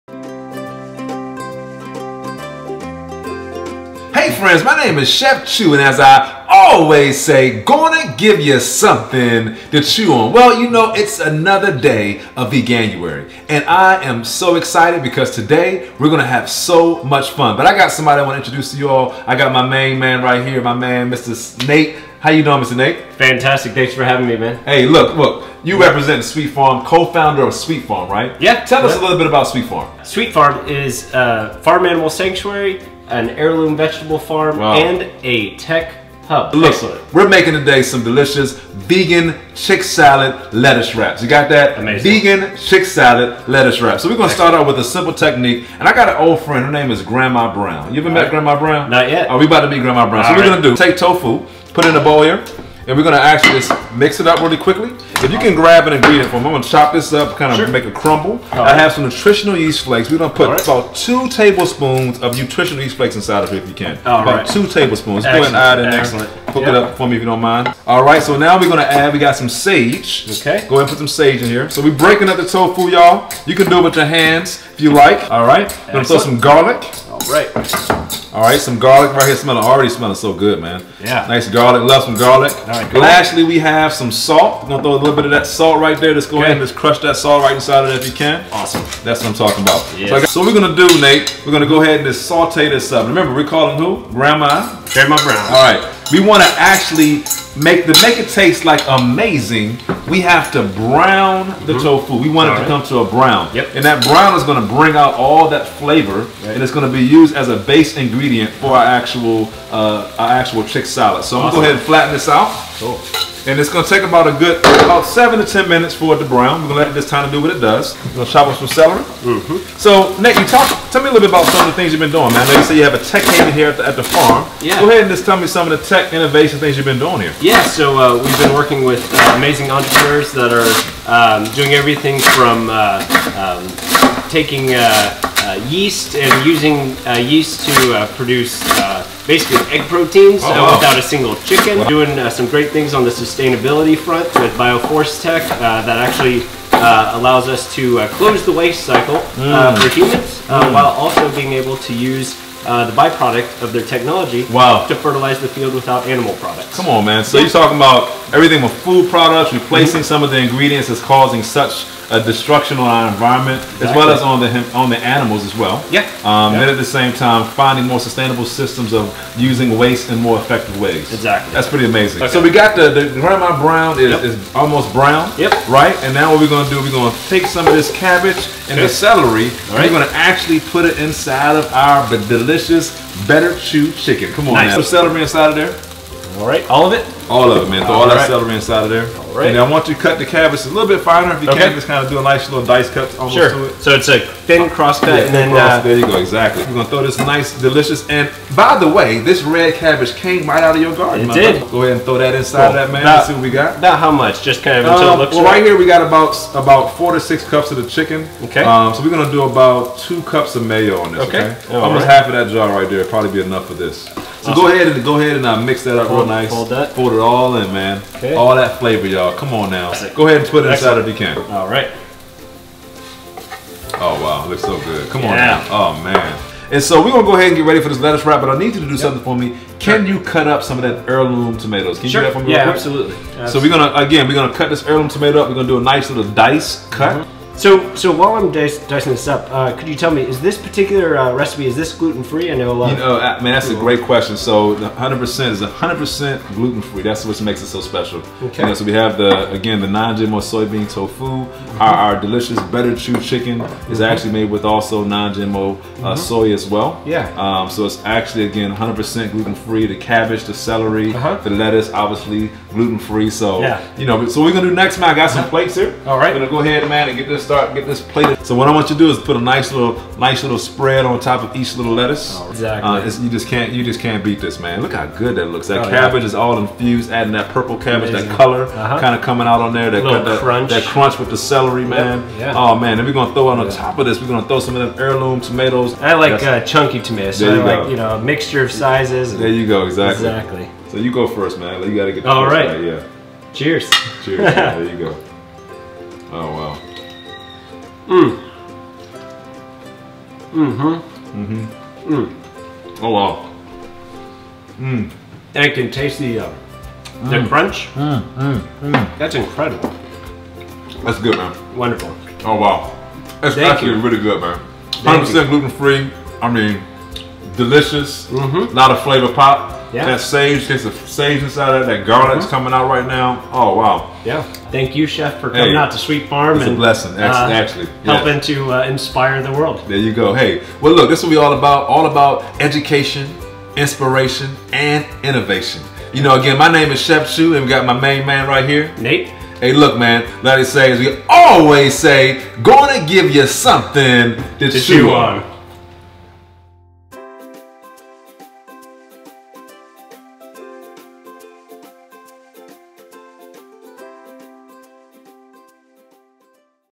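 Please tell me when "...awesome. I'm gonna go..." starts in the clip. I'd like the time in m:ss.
1:51.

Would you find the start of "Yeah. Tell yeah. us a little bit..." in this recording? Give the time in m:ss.
0:28.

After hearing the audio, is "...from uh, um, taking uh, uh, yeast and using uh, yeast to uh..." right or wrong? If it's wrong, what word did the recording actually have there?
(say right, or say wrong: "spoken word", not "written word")
right.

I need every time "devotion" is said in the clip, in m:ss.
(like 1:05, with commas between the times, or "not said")
not said.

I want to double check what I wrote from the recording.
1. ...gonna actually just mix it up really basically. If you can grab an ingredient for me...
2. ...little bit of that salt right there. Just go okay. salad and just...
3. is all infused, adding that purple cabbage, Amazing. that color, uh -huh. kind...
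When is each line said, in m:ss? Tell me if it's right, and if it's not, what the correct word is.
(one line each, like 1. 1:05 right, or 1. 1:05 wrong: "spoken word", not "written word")
1. 0:53 wrong: "quickly", not "basically"
2. 1:24 wrong: "ahead", not "salad"
3. 4:36 right.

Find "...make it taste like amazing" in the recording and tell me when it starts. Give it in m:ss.
1:38.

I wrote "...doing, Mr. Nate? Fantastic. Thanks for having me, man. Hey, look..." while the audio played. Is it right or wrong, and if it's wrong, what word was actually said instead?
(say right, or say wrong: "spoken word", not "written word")
right.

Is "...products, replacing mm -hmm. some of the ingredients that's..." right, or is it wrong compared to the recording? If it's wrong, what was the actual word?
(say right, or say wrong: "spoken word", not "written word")
right.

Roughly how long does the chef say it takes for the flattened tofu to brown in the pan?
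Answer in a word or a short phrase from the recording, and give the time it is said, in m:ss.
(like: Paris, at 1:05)
7 to 10 minutes, at 1:55.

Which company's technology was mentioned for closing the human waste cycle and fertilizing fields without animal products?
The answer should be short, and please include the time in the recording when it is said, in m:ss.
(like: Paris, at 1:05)
Bioforce Tech, at 2:24.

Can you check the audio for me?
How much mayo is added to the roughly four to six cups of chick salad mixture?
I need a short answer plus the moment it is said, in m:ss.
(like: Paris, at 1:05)
2 cups, at 3:29.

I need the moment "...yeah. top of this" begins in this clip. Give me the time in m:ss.
4:43.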